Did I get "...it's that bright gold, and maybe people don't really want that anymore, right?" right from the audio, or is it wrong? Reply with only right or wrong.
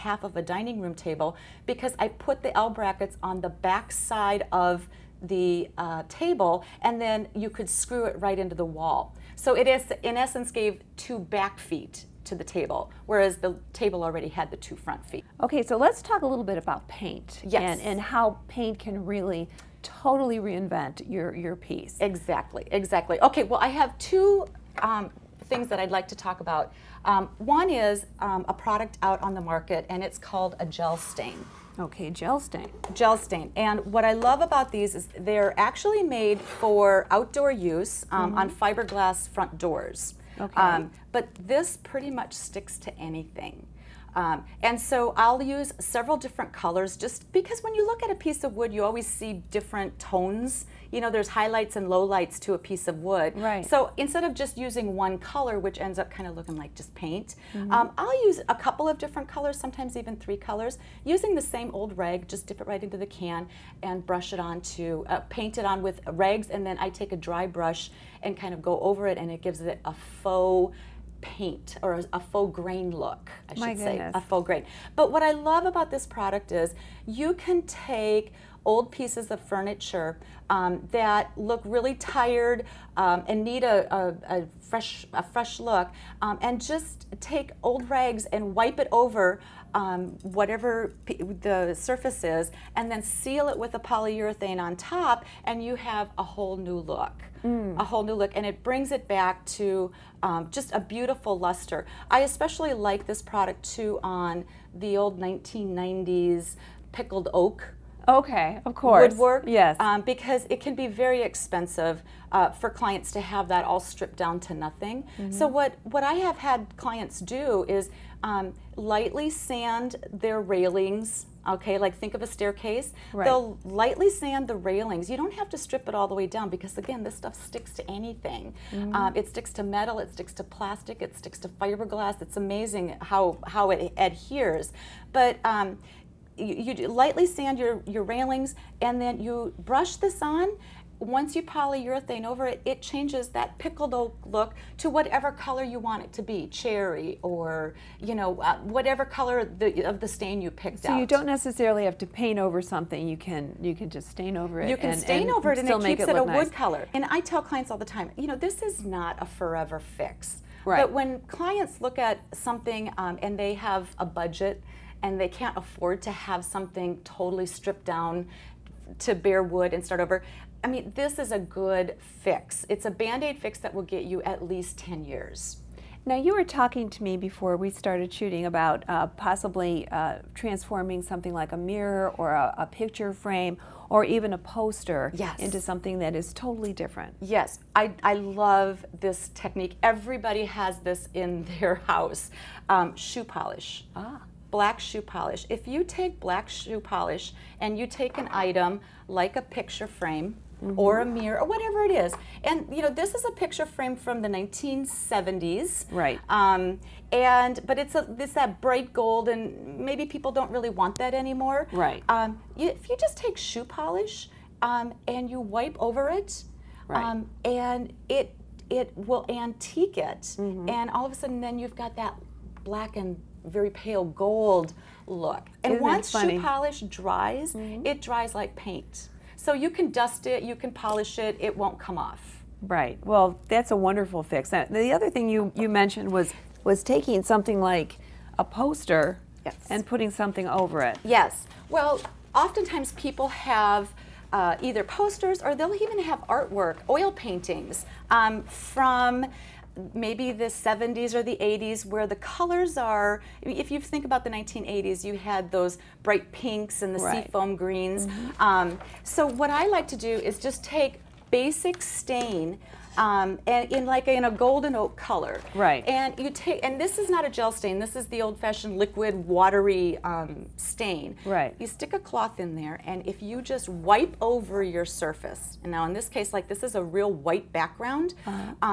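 right.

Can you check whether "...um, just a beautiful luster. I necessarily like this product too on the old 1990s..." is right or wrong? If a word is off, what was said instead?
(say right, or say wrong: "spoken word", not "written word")
wrong: "especially", not "necessarily".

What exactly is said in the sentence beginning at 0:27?
Um, one is um, a product out on the market, and it's called a gel stain.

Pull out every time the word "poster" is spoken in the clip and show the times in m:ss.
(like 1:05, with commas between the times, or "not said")
3:04, 3:58, 4:04.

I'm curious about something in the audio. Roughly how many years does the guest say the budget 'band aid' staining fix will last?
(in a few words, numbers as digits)
10 years.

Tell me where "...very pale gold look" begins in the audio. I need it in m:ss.
3:43.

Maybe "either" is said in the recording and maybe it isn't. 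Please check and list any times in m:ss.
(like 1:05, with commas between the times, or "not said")
4:04.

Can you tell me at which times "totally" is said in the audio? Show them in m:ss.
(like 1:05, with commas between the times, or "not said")
0:19, 2:47, 3:06.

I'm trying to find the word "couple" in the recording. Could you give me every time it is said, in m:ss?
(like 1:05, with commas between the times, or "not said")
0:58.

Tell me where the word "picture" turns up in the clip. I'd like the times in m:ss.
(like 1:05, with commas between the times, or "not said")
3:02, 3:19, 3:23.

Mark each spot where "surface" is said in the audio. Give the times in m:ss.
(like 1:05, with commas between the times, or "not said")
1:31, 4:34.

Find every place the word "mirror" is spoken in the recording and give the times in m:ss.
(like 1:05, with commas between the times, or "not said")
3:01, 3:21.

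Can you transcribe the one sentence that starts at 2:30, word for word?
So you don't necessarily have to paint over something.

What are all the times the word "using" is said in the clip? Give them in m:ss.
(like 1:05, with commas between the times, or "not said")
0:54, 1:01.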